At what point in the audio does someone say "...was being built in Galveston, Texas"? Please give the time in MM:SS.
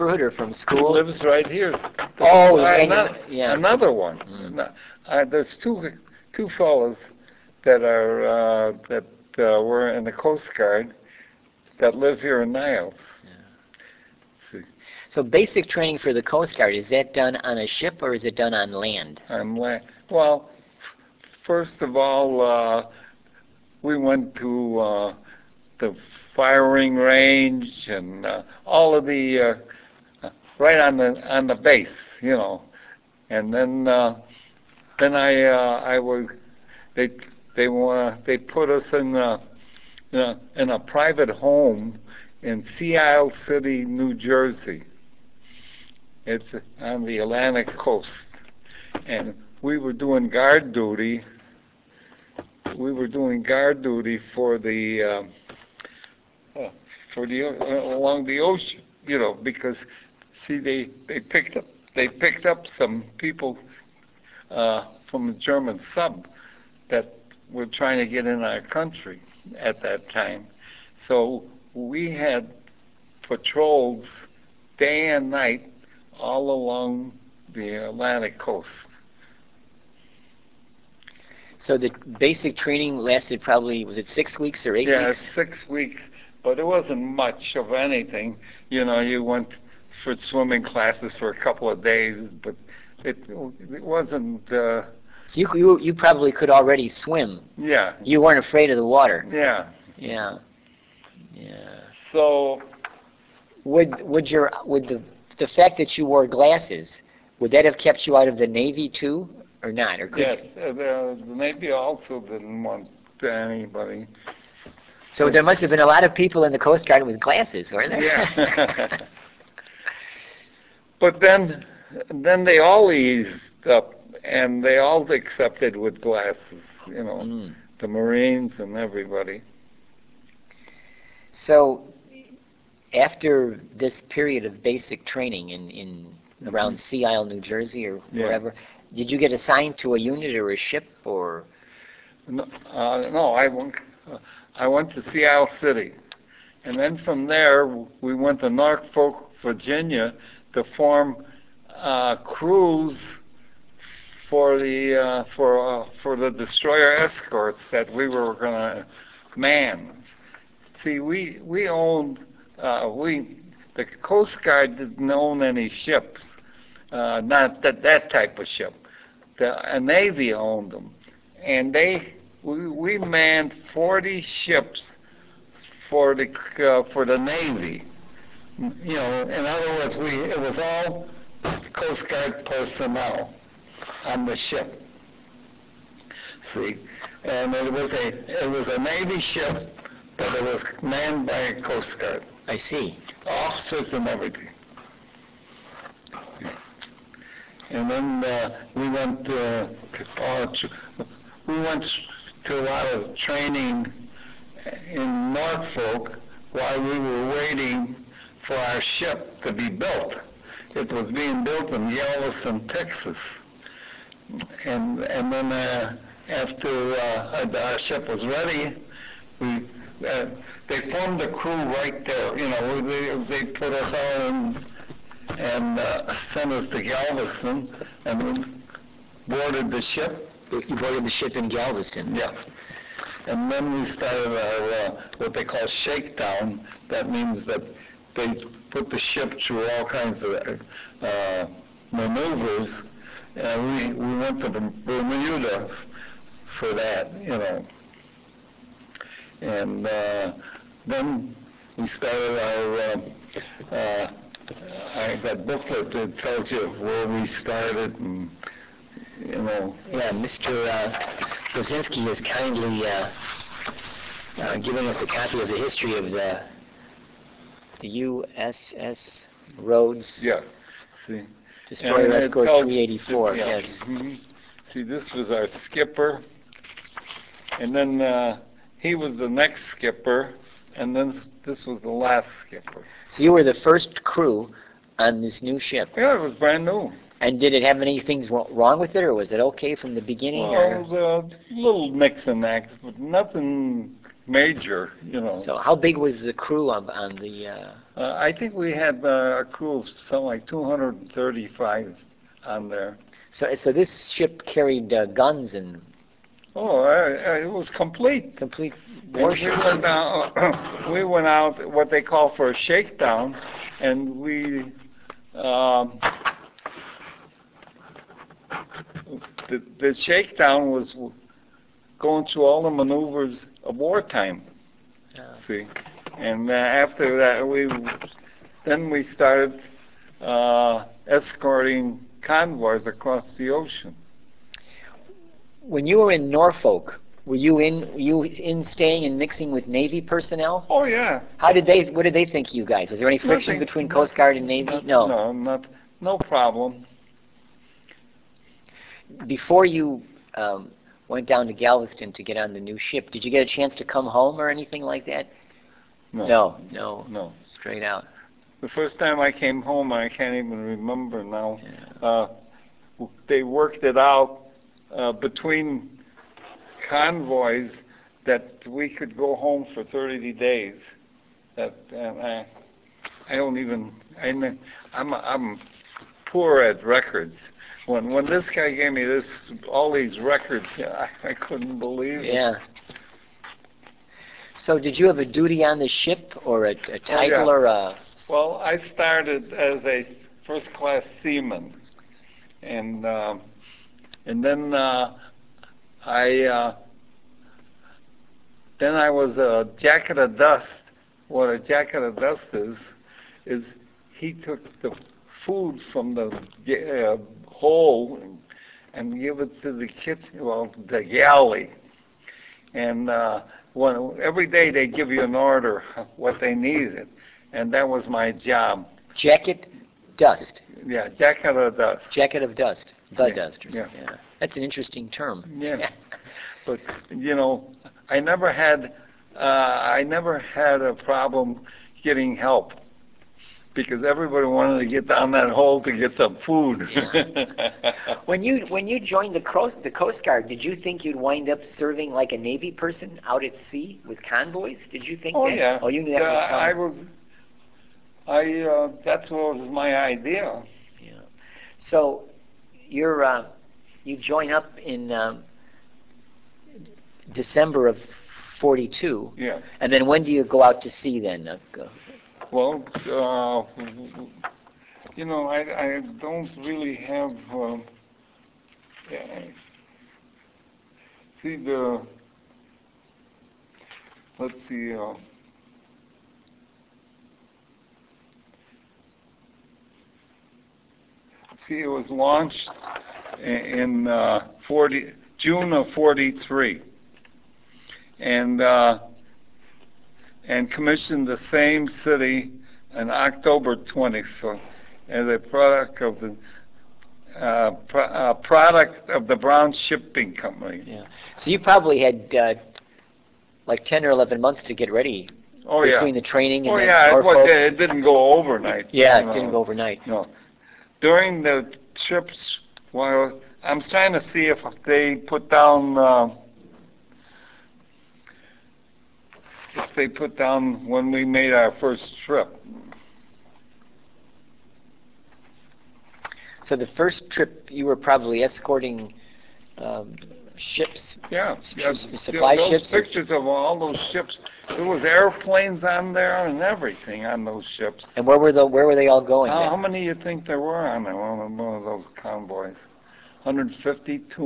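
03:30.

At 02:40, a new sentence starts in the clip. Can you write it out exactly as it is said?
See, we, we owned, uh, we, the Coast Guard didn't own any ships, uh, not that, that type of ship.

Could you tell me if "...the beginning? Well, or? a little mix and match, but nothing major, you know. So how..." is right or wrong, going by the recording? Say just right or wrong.
right.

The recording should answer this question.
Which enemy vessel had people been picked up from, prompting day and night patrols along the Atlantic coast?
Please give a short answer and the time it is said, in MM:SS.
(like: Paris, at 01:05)
German sub, at 01:05.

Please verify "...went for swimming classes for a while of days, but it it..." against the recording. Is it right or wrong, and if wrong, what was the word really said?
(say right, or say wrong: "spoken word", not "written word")
wrong: "couple", not "while".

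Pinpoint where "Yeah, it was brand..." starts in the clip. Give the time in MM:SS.
04:45.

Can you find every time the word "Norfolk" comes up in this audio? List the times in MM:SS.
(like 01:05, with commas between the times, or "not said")
02:28, 03:25, 05:36.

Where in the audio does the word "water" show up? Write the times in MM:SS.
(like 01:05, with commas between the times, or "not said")
01:38.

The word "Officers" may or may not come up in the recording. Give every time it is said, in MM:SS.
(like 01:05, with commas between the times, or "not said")
03:13.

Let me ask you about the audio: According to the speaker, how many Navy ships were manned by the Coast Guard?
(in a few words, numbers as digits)
40.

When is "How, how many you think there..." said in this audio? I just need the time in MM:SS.
08:59.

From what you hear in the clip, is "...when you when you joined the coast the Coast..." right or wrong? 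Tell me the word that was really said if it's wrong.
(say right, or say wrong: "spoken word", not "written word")
right.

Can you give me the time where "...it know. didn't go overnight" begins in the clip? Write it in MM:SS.
08:29.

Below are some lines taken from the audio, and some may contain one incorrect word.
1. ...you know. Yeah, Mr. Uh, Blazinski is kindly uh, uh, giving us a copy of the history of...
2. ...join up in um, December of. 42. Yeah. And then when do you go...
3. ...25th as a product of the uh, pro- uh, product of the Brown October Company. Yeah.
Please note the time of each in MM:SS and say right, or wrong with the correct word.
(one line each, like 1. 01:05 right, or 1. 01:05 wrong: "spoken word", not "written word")
1. 04:19 right
2. 07:34 right
3. 08:13 wrong: "Shipping", not "October".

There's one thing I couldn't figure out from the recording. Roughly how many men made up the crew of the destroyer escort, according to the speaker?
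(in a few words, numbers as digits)
235.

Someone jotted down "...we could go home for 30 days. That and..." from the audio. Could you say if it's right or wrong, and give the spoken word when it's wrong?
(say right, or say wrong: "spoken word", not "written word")
right.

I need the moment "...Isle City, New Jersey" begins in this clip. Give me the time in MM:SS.
00:42.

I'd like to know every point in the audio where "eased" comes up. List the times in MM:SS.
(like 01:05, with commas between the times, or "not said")
02:02.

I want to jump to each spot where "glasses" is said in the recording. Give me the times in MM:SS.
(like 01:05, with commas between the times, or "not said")
01:46, 01:57, 02:06.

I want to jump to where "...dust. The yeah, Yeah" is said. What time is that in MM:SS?
07:02.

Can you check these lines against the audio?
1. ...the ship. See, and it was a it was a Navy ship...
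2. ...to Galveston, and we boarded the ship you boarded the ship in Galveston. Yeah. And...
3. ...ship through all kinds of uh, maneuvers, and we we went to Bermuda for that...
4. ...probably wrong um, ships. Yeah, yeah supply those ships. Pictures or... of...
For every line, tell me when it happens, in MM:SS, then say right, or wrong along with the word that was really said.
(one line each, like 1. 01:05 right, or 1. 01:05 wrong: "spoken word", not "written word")
1. 03:04 right
2. 03:46 right
3. 03:58 right
4. 08:47 wrong: "escorting", not "wrong".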